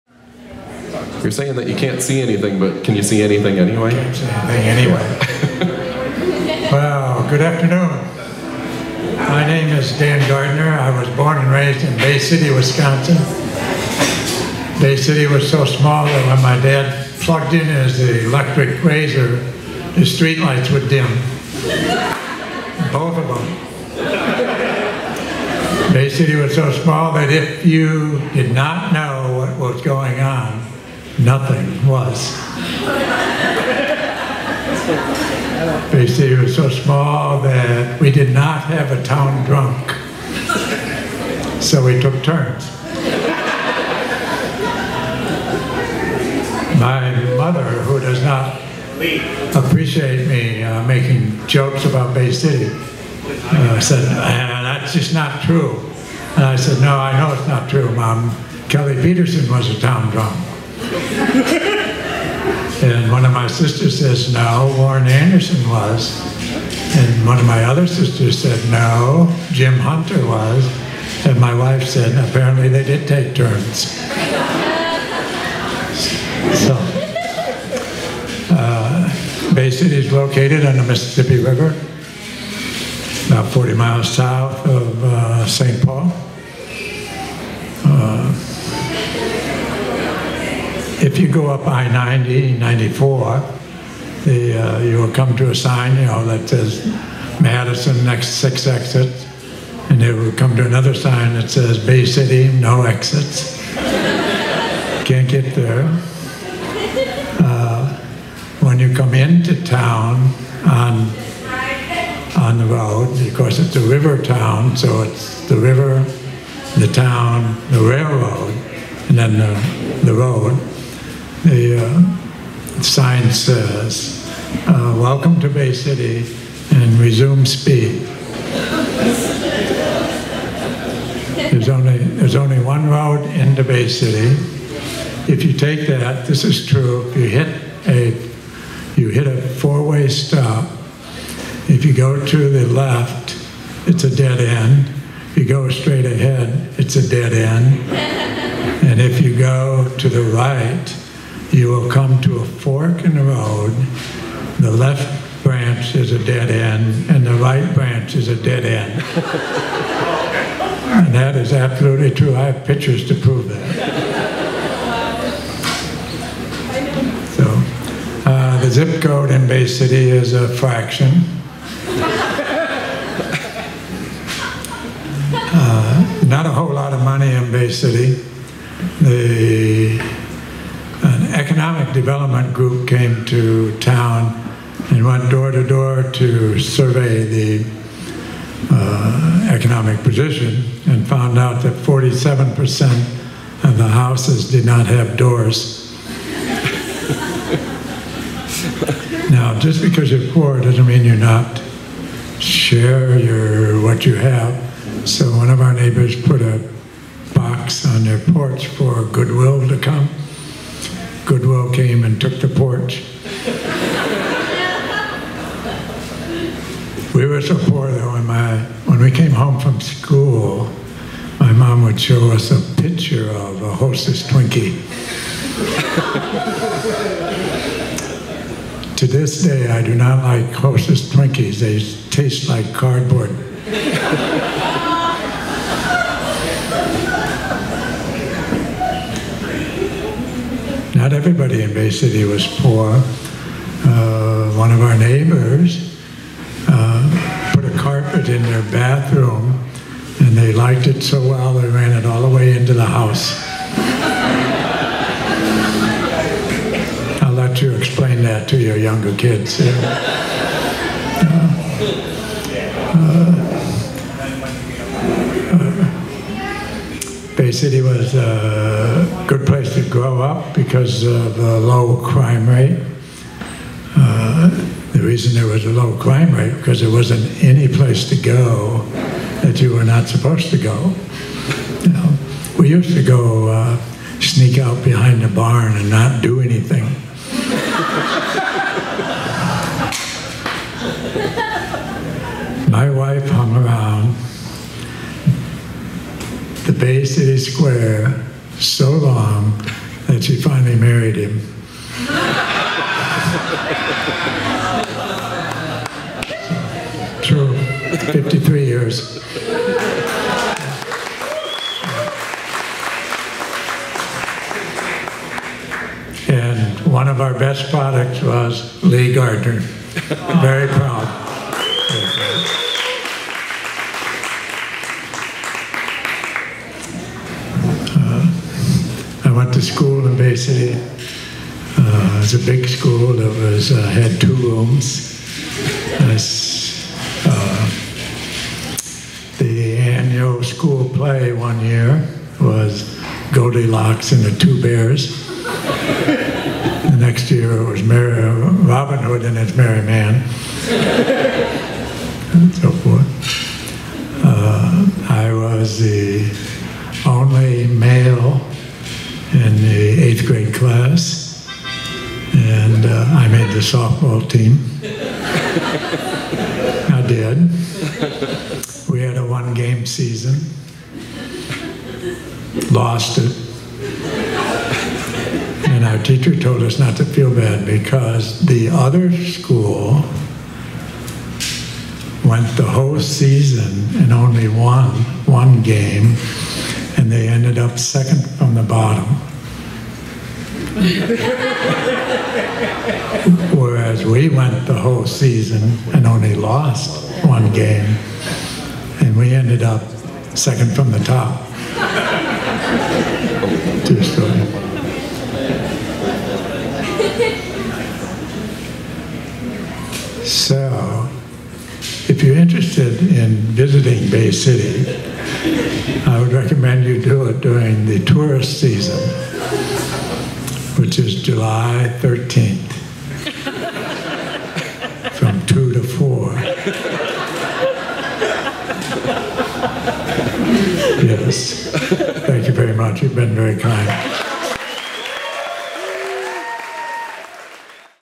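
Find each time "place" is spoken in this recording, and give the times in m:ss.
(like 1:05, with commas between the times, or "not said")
4:29, 4:37.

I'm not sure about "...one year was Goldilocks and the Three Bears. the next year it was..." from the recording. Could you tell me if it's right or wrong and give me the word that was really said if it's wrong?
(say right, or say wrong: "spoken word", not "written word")
wrong: "Two", not "Three".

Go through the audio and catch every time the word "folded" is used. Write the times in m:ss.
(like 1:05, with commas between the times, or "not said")
not said.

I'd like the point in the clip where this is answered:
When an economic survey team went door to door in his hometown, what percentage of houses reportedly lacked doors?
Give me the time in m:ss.
3:11.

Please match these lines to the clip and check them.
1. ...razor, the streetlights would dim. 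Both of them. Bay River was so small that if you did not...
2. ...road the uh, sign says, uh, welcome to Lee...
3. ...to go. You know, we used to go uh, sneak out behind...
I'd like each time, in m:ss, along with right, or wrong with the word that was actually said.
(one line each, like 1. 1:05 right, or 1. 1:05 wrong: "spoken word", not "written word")
1. 0:18 wrong: "City", not "River"
2. 2:00 wrong: "Bay", not "Lee"
3. 4:40 right.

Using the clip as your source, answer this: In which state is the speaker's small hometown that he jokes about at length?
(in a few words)
Wisconsin.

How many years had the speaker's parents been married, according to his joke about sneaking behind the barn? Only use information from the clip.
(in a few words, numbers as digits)
53.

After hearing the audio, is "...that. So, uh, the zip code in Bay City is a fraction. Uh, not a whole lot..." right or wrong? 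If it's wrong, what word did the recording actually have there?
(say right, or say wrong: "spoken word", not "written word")
right.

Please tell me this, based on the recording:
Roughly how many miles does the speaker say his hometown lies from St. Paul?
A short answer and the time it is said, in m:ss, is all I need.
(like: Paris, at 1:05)
40 miles, at 1:23.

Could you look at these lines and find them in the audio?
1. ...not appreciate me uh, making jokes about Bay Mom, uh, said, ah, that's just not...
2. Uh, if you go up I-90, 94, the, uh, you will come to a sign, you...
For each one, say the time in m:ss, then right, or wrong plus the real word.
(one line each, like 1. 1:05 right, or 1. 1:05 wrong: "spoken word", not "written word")
1. 0:48 wrong: "City", not "Mom"
2. 1:27 right.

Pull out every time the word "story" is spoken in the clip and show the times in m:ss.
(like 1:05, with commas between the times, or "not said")
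6:44.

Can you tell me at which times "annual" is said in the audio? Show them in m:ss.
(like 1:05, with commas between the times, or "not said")
5:39.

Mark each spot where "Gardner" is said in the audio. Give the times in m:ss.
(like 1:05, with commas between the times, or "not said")
0:10, 5:19.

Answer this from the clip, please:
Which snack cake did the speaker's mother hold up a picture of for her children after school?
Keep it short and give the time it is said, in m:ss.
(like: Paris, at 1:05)
Hostess Twinkie, at 3:43.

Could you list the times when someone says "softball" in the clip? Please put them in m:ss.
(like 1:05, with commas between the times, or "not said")
6:03.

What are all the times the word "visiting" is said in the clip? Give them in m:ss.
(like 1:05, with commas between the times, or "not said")
6:53.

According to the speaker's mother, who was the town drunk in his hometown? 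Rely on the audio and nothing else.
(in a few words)
Kelly Peterson.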